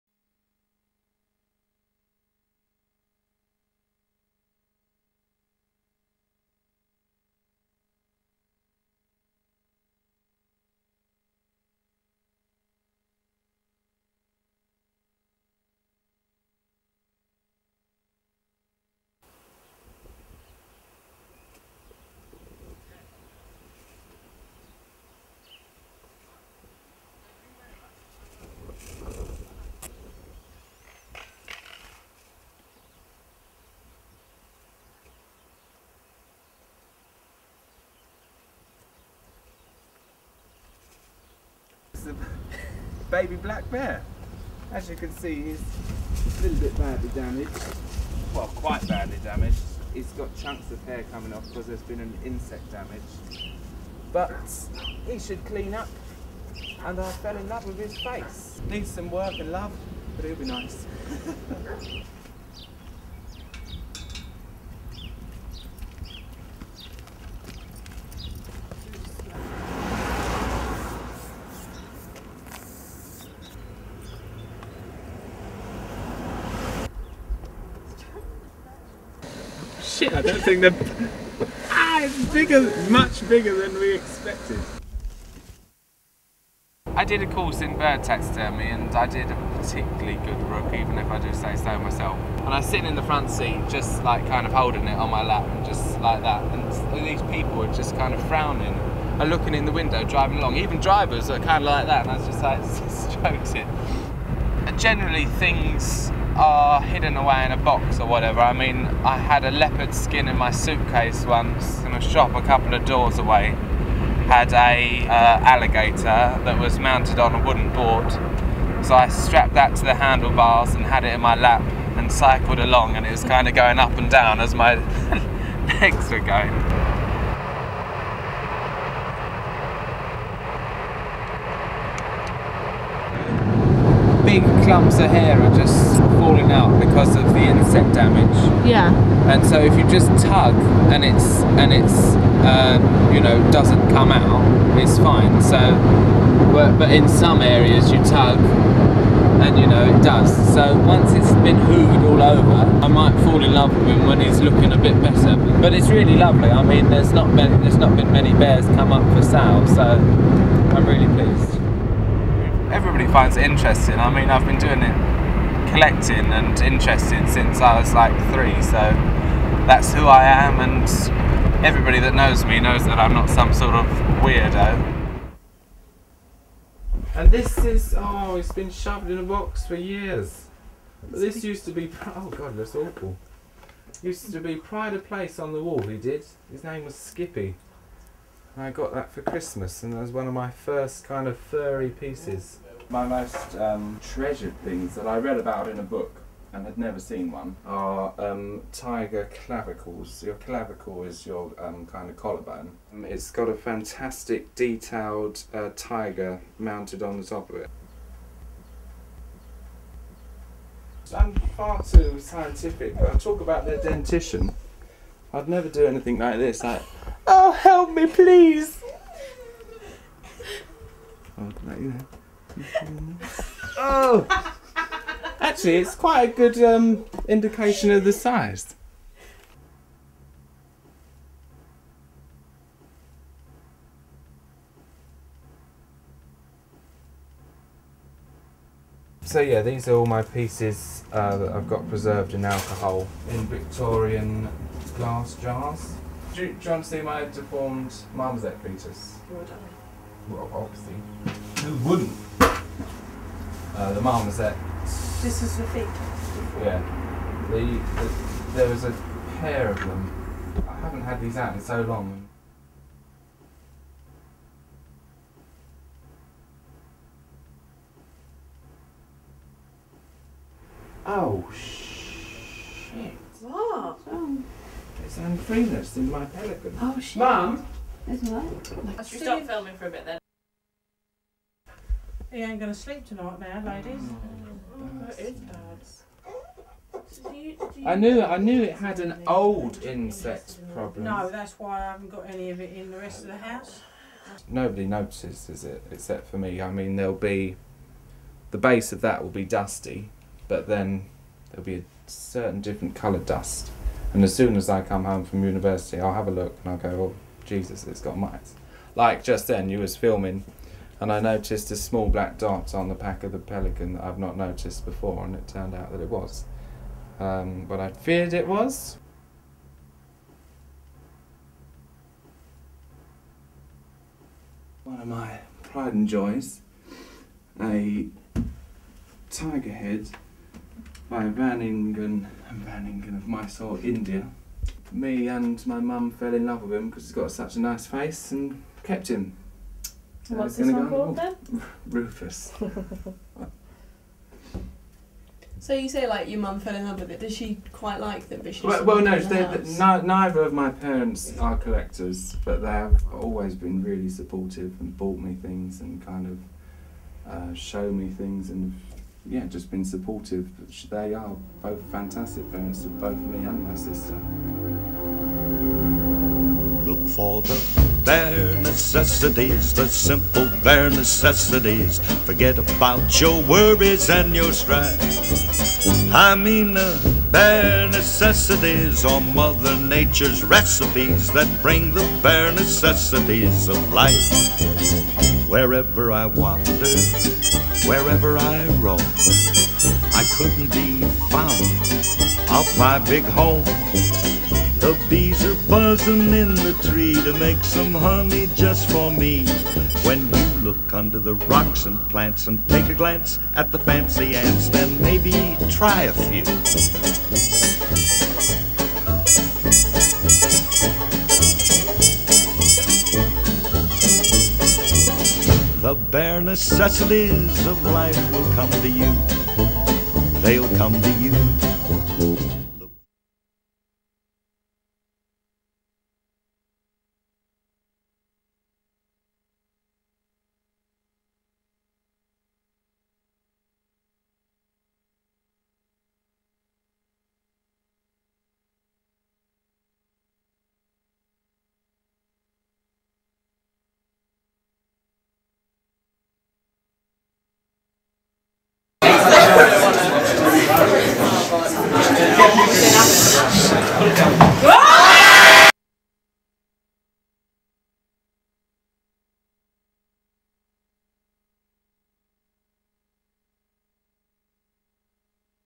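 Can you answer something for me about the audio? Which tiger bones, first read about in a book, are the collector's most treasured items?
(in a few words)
Tiger clavicles.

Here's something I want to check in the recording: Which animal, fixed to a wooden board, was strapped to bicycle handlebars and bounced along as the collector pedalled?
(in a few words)
Alligator.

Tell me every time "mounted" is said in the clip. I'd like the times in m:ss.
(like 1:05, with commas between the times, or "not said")
1:56, 3:26.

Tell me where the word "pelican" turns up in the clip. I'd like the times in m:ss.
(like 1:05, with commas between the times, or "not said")
4:36, 5:13.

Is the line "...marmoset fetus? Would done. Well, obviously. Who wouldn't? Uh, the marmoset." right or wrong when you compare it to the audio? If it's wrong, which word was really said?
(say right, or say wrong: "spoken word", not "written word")
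right.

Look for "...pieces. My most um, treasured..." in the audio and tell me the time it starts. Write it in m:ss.
3:11.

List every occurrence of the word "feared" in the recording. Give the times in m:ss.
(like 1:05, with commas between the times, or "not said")
5:17.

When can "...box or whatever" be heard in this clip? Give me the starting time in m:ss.
1:47.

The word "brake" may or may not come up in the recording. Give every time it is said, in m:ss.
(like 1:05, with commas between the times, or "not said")
not said.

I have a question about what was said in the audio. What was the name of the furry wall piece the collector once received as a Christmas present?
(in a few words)
Skippy.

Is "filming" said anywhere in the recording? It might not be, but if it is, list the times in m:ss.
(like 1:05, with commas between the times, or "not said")
4:39, 5:09.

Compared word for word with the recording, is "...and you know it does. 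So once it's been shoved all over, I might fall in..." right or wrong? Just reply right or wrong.
wrong.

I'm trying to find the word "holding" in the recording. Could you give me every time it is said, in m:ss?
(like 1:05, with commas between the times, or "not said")
1:34.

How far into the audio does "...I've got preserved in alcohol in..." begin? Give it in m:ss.
4:01.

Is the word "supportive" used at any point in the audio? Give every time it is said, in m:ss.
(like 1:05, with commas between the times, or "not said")
5:54, 5:59.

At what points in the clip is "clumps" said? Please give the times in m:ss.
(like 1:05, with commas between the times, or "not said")
2:14.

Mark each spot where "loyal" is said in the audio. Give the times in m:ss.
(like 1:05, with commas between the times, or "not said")
not said.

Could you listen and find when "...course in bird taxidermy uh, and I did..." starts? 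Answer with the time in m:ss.
1:27.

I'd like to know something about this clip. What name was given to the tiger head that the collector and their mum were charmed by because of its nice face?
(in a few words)
Rufus.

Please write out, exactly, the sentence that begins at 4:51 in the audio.
No, that's why I haven't got any of it in the rest of the house.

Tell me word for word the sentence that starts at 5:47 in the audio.
Does she quite like that vicious?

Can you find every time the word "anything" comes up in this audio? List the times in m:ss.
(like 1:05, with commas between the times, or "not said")
3:35.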